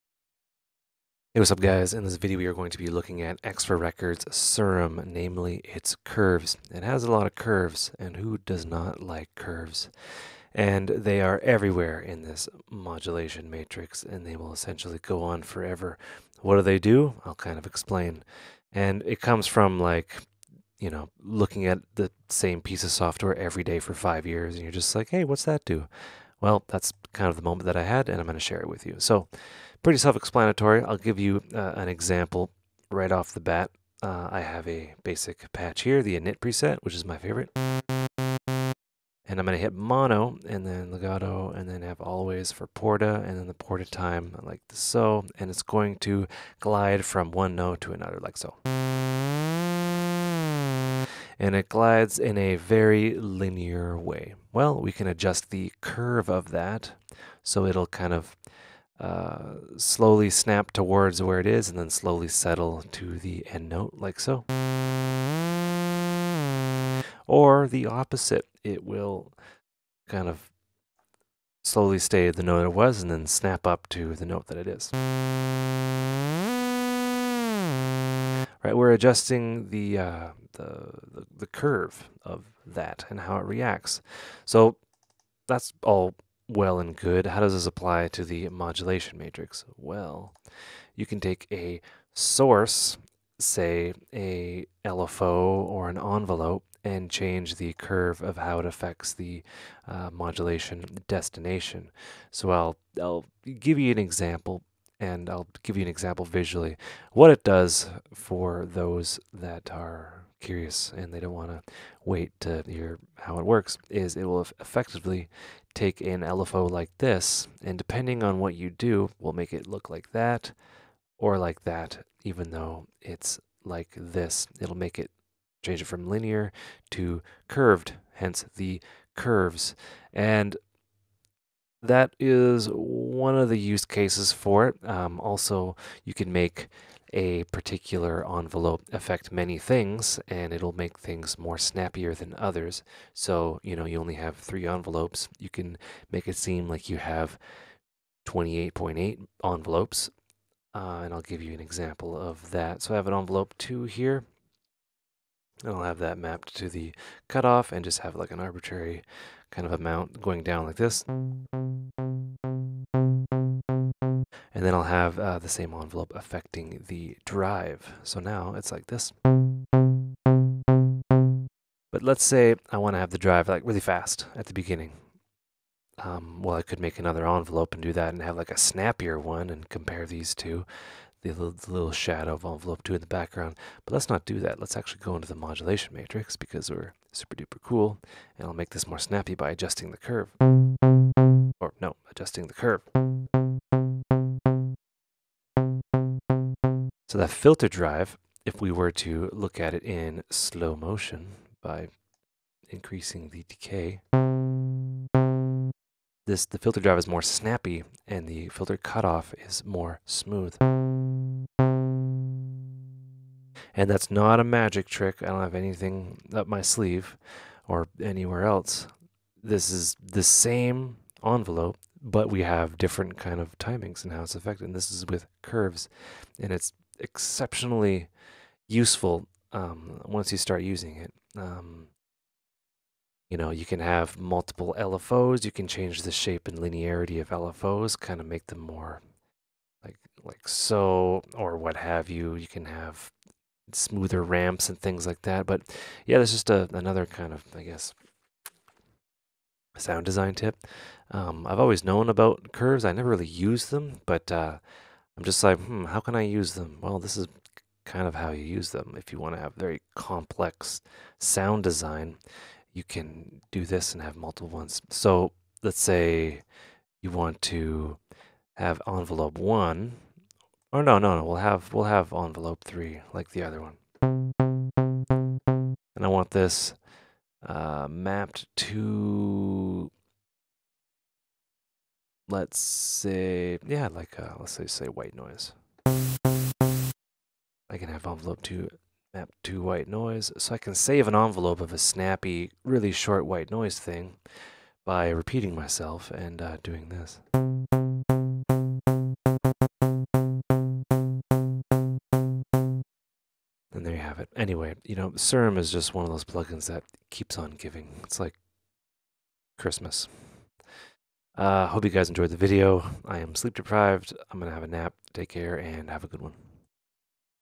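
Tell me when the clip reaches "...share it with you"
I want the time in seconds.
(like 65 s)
28 s.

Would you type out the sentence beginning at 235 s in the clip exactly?
You can change the shape and linearity of LFOs, kind of make them more like like so, or what have you.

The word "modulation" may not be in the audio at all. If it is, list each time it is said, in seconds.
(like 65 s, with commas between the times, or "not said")
12 s, 88 s, 100 s, 185 s.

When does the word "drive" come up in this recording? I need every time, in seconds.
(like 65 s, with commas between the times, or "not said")
167 s, 173 s, 197 s, 206 s.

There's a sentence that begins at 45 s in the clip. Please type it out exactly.
And it's going to glide from one note to another like so.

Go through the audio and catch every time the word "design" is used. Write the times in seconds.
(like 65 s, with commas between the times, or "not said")
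250 s, 261 s.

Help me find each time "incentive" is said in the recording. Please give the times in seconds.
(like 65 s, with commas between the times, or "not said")
not said.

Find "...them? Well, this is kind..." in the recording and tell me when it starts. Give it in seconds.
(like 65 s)
256 s.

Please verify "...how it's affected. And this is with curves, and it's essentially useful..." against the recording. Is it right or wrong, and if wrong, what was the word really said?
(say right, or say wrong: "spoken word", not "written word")
wrong: "exceptionally", not "essentially".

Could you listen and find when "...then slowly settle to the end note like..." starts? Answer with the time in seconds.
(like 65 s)
61 s.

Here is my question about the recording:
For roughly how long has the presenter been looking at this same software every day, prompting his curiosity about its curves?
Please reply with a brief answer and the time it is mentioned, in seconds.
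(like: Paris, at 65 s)
5 years, at 23 s.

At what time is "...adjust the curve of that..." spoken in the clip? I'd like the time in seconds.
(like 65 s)
55 s.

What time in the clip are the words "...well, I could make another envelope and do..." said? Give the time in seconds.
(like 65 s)
176 s.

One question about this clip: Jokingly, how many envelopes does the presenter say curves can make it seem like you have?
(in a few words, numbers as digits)
28.8.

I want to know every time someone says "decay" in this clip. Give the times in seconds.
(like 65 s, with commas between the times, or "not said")
203 s.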